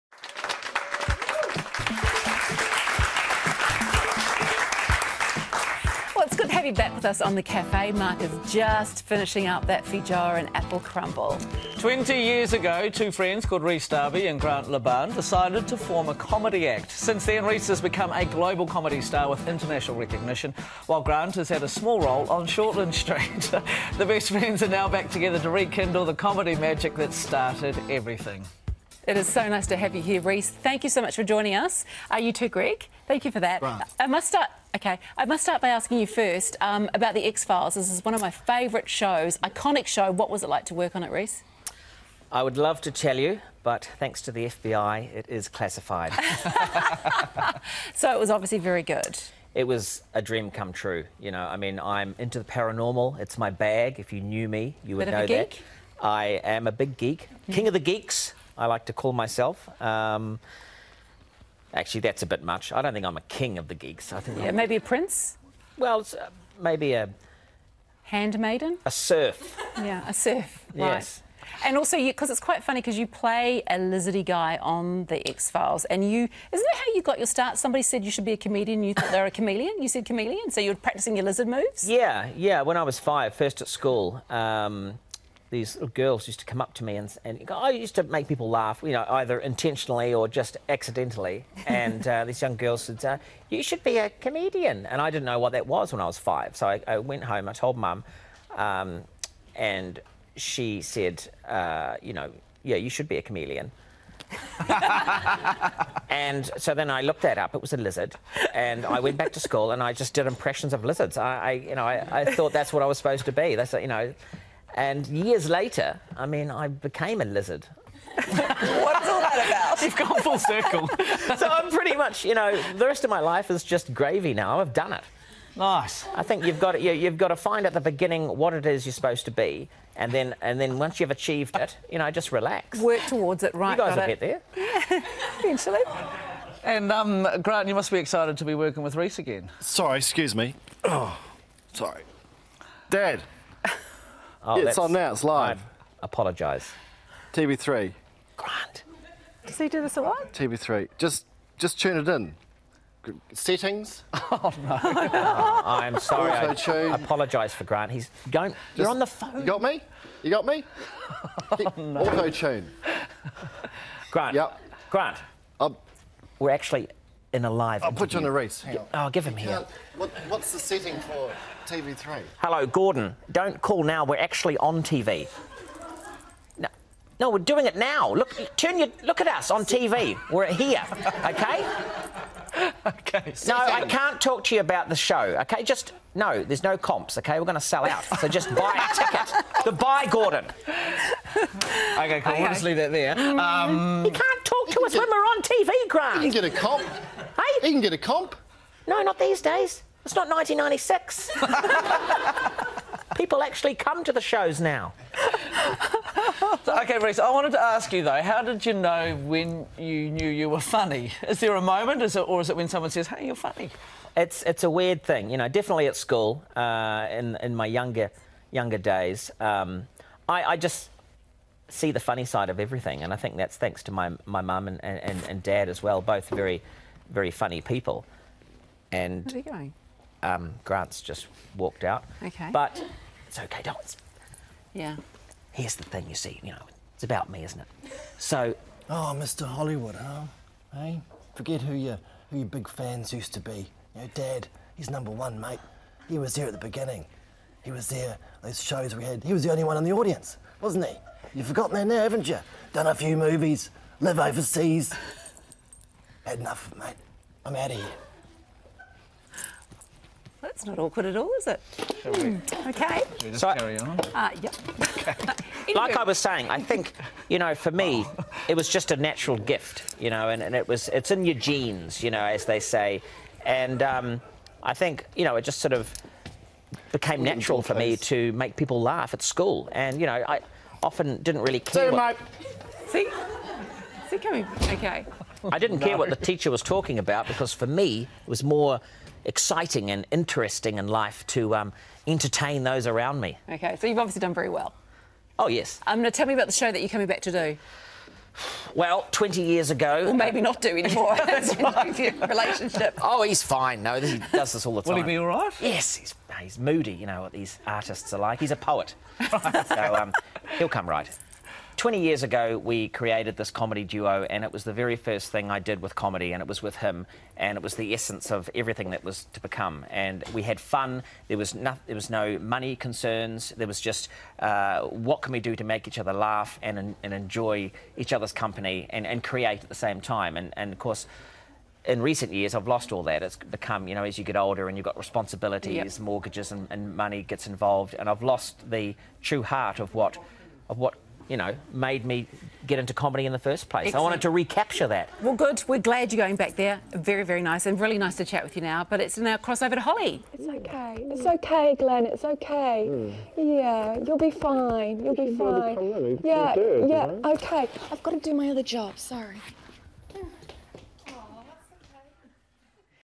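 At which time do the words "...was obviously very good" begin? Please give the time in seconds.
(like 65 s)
48 s.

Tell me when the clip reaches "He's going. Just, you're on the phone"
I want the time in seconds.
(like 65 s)
157 s.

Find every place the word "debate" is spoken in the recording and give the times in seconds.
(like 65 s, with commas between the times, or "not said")
not said.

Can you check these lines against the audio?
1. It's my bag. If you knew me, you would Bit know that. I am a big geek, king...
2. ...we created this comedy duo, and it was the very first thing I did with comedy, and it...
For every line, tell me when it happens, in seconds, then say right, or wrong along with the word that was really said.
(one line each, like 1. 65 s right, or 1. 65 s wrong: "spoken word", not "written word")
1. 53 s right
2. 312 s right.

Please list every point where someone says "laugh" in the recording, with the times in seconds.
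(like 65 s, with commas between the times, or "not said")
88 s, 278 s, 326 s.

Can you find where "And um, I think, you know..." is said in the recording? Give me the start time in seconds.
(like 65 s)
273 s.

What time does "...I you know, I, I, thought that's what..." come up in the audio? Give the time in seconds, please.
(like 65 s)
111 s.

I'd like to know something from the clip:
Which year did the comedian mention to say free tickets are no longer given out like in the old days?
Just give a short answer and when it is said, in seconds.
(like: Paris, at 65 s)
1996, at 200 s.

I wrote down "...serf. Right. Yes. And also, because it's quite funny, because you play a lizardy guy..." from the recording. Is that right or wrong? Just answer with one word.
right.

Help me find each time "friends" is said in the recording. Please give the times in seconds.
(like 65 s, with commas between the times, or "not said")
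13 s, 24 s.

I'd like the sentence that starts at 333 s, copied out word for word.
It's become, you know, as you get older and you've got responsibilities, yep.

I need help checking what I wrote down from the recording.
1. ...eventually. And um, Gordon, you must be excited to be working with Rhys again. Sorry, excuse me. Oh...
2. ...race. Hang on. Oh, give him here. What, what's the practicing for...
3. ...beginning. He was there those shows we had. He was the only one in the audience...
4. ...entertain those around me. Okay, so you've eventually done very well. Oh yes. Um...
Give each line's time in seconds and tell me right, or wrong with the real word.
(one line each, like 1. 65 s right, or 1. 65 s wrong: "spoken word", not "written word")
1. 135 s wrong: "Grant", not "Gordon"
2. 168 s wrong: "setting", not "practicing"
3. 246 s right
4. 292 s wrong: "obviously", not "eventually".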